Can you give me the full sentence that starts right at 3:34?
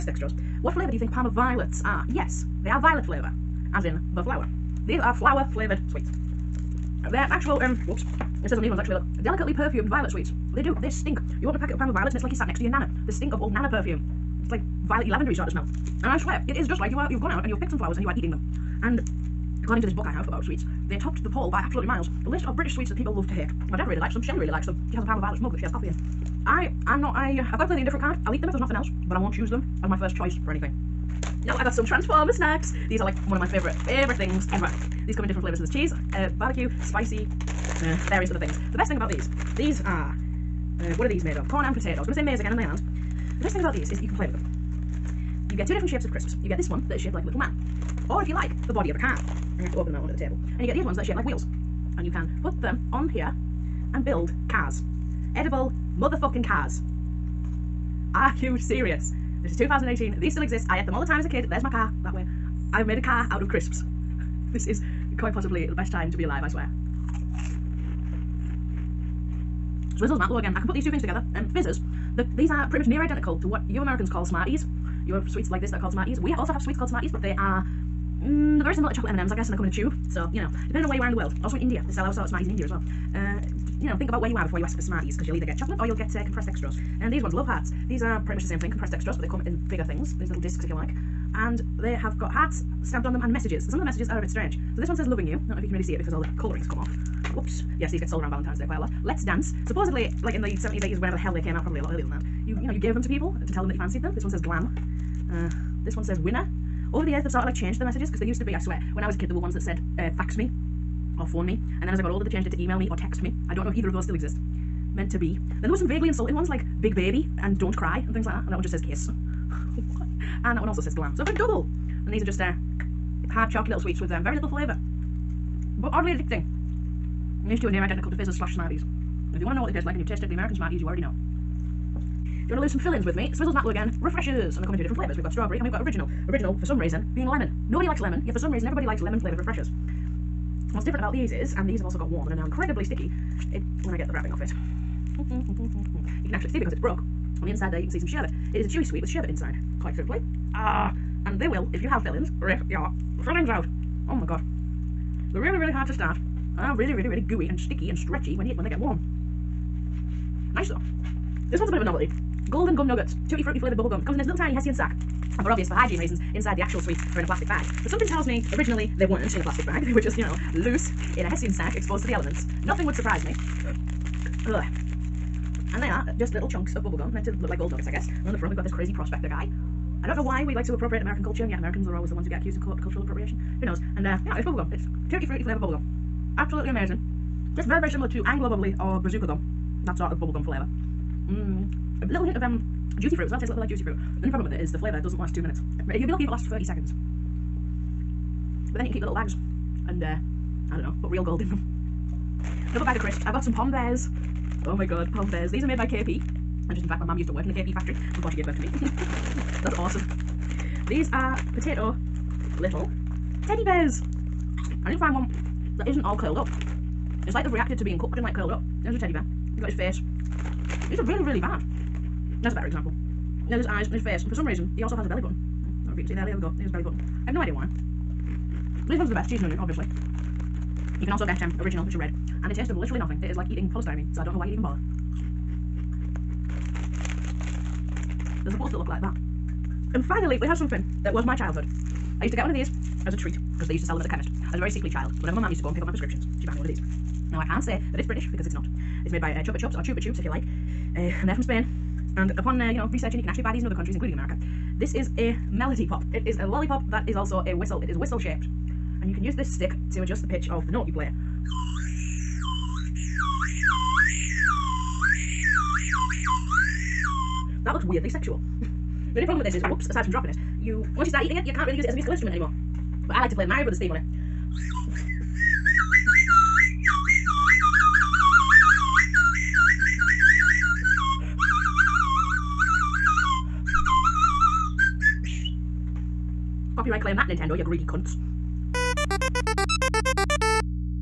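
I didn't find one that isn't all curled up.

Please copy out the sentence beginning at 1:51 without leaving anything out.
And then as I got older, they changed it to email me or text me.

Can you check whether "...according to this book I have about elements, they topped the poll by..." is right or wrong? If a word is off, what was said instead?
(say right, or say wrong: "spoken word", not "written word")
wrong: "sweets", not "elements".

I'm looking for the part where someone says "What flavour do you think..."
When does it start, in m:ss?
0:00.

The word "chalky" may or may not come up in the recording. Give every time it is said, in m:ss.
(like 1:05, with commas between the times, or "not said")
2:03.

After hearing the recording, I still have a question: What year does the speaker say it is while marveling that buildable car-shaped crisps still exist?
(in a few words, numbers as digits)
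2018.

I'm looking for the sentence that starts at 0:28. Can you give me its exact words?
I'll eat them if there's nothing else, but I won't choose them as my first choice for anything.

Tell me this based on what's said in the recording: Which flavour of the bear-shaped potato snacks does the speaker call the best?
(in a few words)
Cheese and onion.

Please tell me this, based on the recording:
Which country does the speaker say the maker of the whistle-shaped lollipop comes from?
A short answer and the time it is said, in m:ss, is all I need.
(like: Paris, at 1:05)
Spain, at 4:11.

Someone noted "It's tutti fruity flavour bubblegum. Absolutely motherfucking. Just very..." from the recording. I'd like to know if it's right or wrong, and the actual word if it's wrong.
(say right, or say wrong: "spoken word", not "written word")
wrong: "amazing", not "motherfucking".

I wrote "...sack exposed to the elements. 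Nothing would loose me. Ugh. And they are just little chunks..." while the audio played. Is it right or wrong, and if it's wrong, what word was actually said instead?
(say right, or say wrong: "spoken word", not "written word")
wrong: "surprise", not "loose".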